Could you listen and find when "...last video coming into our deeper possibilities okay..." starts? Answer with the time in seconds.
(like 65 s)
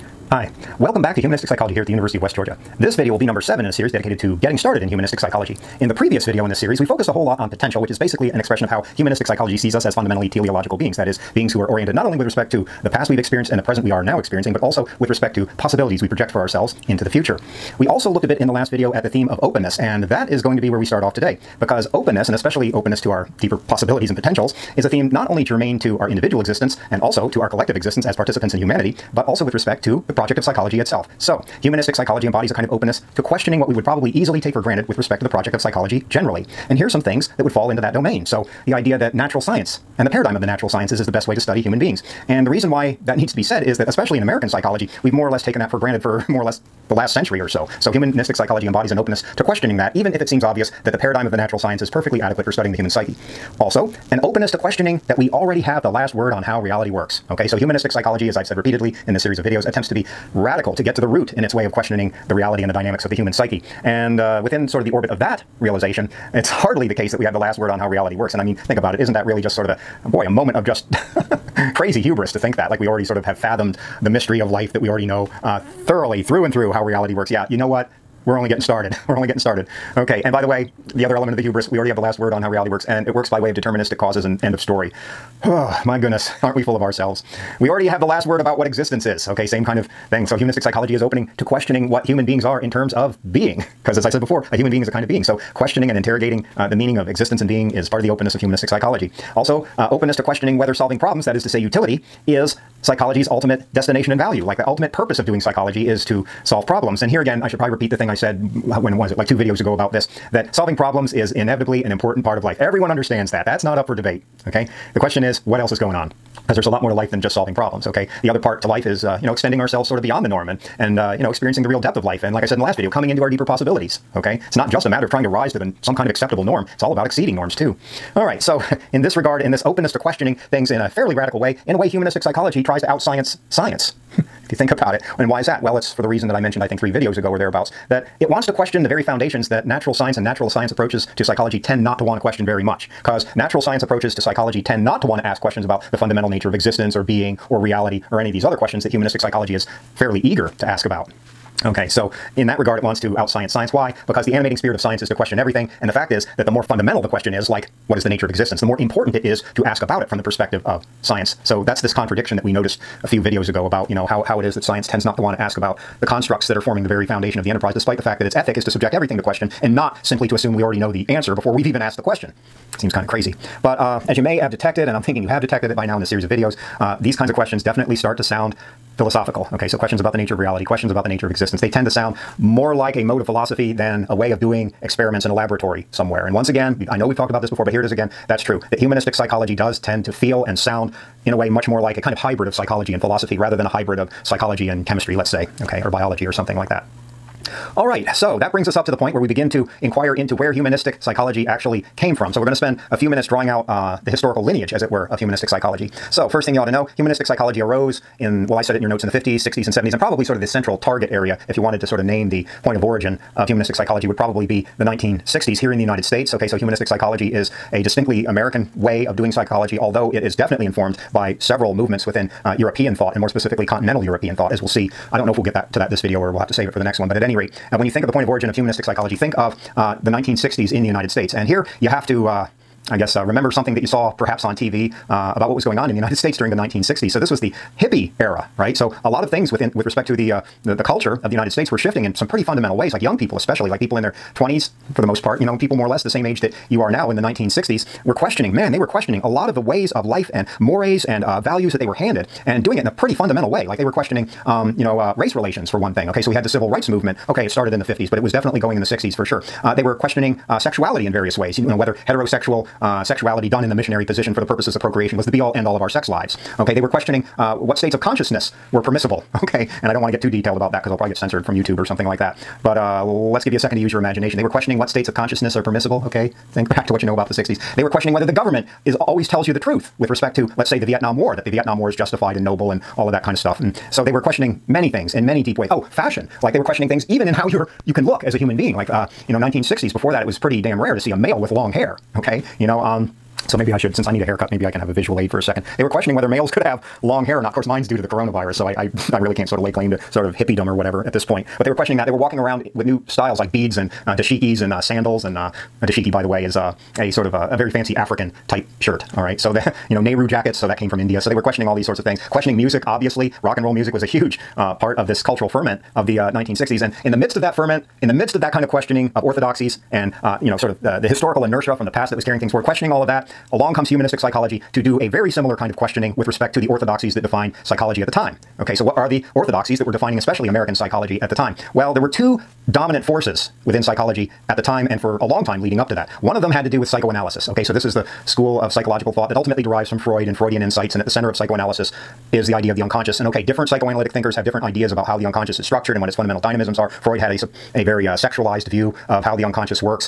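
122 s.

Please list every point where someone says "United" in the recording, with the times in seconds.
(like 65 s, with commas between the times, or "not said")
215 s, 230 s, 235 s, 241 s.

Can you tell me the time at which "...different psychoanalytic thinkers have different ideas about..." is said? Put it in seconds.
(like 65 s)
343 s.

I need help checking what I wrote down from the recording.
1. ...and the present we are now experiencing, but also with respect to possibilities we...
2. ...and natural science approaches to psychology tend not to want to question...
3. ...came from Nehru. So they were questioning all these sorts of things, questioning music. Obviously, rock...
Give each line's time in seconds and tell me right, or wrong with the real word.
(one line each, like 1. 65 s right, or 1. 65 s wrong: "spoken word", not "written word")
1. 13 s right
2. 140 s right
3. 310 s wrong: "India", not "Nehru".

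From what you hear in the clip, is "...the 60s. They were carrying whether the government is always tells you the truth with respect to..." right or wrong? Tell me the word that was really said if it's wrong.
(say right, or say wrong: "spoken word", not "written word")
wrong: "questioning", not "carrying".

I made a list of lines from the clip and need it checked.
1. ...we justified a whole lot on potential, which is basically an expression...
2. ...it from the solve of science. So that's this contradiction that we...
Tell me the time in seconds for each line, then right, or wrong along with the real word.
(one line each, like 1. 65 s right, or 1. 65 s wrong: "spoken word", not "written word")
1. 6 s wrong: "focused", not "justified"
2. 160 s wrong: "perspective", not "solve".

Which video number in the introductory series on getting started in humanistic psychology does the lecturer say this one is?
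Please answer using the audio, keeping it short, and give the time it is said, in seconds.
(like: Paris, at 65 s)
7, at 3 s.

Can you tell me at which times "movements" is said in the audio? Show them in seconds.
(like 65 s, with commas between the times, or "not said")
221 s, 256 s.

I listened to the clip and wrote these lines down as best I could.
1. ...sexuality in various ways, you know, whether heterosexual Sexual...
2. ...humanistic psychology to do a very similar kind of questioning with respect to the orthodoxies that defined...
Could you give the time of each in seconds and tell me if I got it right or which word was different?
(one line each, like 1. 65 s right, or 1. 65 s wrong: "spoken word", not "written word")
1. 260 s right
2. 323 s right.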